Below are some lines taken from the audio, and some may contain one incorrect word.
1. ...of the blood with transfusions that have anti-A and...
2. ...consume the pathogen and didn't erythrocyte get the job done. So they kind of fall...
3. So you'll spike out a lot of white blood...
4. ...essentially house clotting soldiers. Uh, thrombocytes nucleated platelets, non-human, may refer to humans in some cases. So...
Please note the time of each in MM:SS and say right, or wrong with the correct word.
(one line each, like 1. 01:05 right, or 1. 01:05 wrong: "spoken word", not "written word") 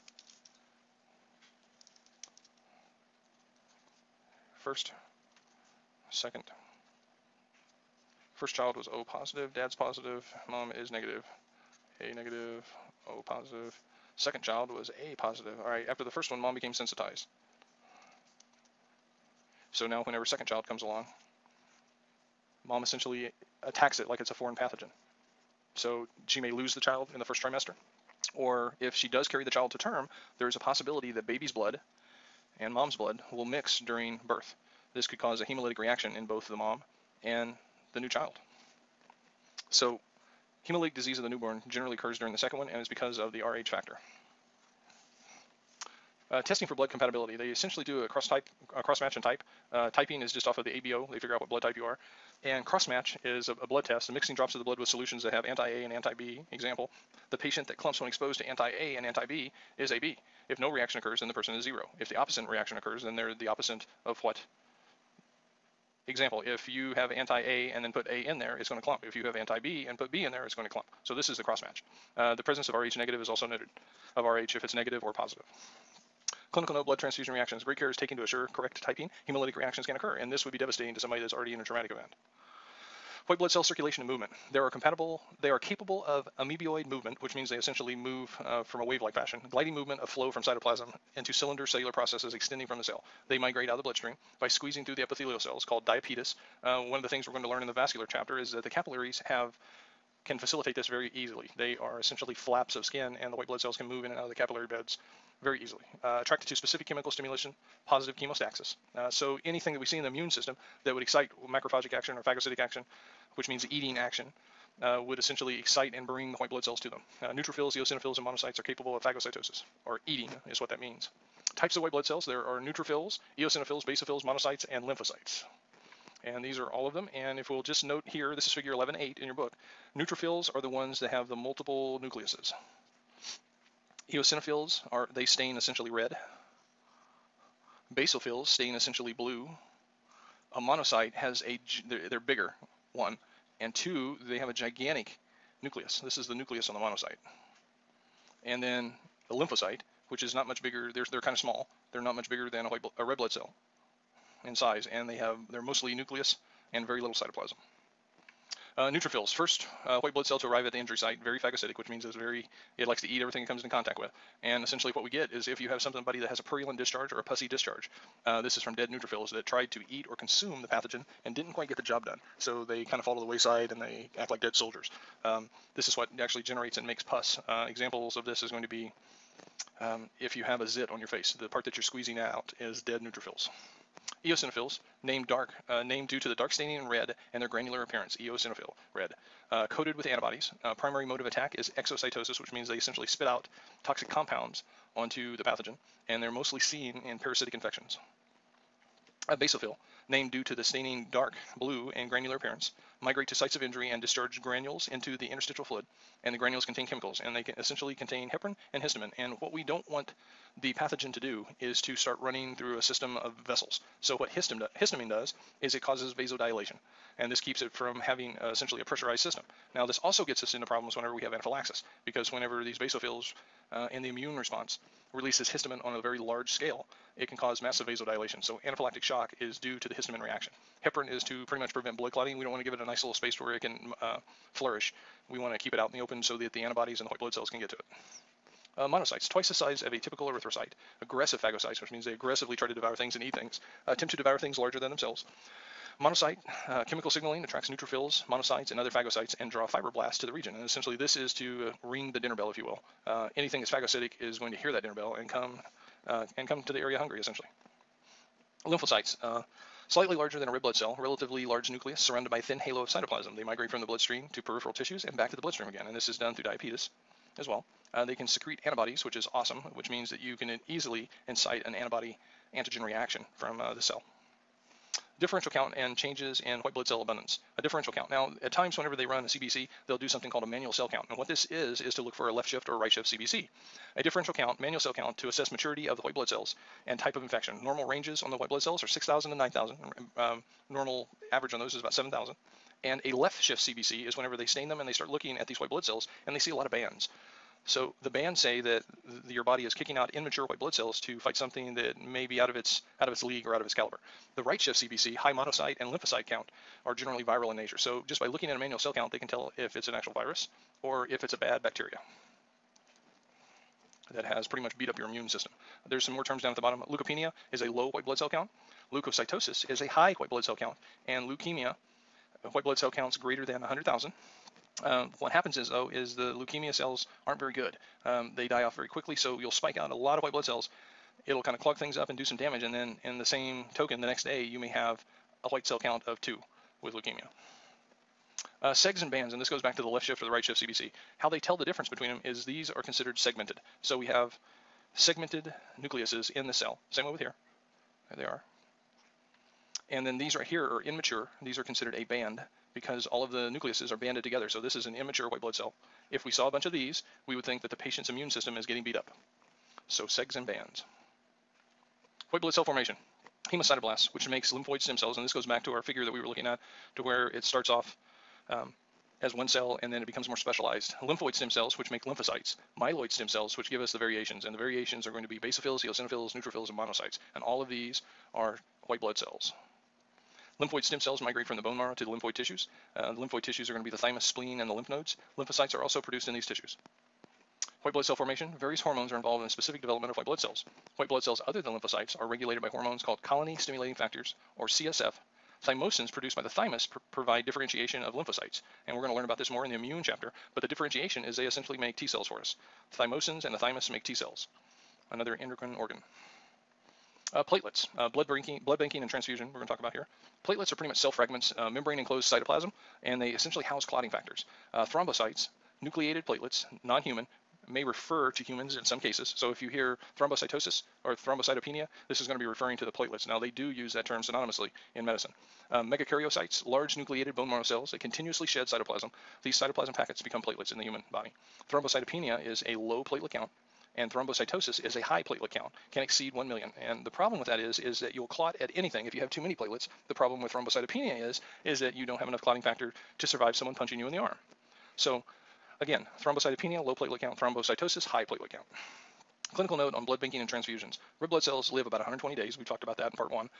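1. 00:54 wrong: "solutions", not "transfusions"
2. 02:50 wrong: "quite", not "erythrocyte"
3. 05:29 right
4. 06:53 wrong: "factors", not "soldiers".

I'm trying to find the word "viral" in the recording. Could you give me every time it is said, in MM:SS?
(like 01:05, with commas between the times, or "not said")
05:07.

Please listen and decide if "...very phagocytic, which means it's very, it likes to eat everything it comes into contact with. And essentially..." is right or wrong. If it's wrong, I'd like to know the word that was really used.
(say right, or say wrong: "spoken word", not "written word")
right.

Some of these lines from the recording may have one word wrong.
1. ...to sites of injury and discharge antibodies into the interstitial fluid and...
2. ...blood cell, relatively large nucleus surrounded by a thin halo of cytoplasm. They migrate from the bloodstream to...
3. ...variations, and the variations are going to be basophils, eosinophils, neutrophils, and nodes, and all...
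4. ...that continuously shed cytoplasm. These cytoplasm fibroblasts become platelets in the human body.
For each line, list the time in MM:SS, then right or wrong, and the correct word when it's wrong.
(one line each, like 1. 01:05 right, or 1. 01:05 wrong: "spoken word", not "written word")
1. 03:23 wrong: "granules", not "antibodies"
2. 04:20 right
3. 06:13 wrong: "monocytes", not "nodes"
4. 07:07 wrong: "packets", not "fibroblasts".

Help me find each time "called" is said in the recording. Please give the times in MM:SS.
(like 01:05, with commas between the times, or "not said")
01:35, 04:40, 06:33.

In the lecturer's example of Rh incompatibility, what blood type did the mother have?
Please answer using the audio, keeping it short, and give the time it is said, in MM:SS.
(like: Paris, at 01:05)
A negative, at 00:11.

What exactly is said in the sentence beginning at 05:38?
Uh, segs and bands, and this goes back to the left shift or the right shift CBC.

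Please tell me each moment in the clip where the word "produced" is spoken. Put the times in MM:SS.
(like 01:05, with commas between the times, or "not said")
06:25, 06:36.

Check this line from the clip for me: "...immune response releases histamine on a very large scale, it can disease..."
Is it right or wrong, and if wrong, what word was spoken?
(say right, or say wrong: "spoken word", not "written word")
wrong: "cause", not "disease".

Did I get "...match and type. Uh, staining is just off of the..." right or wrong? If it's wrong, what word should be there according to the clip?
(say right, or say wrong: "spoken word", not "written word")
wrong: "typing", not "staining".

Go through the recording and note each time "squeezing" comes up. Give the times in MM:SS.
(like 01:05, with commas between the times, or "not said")
01:34, 03:01.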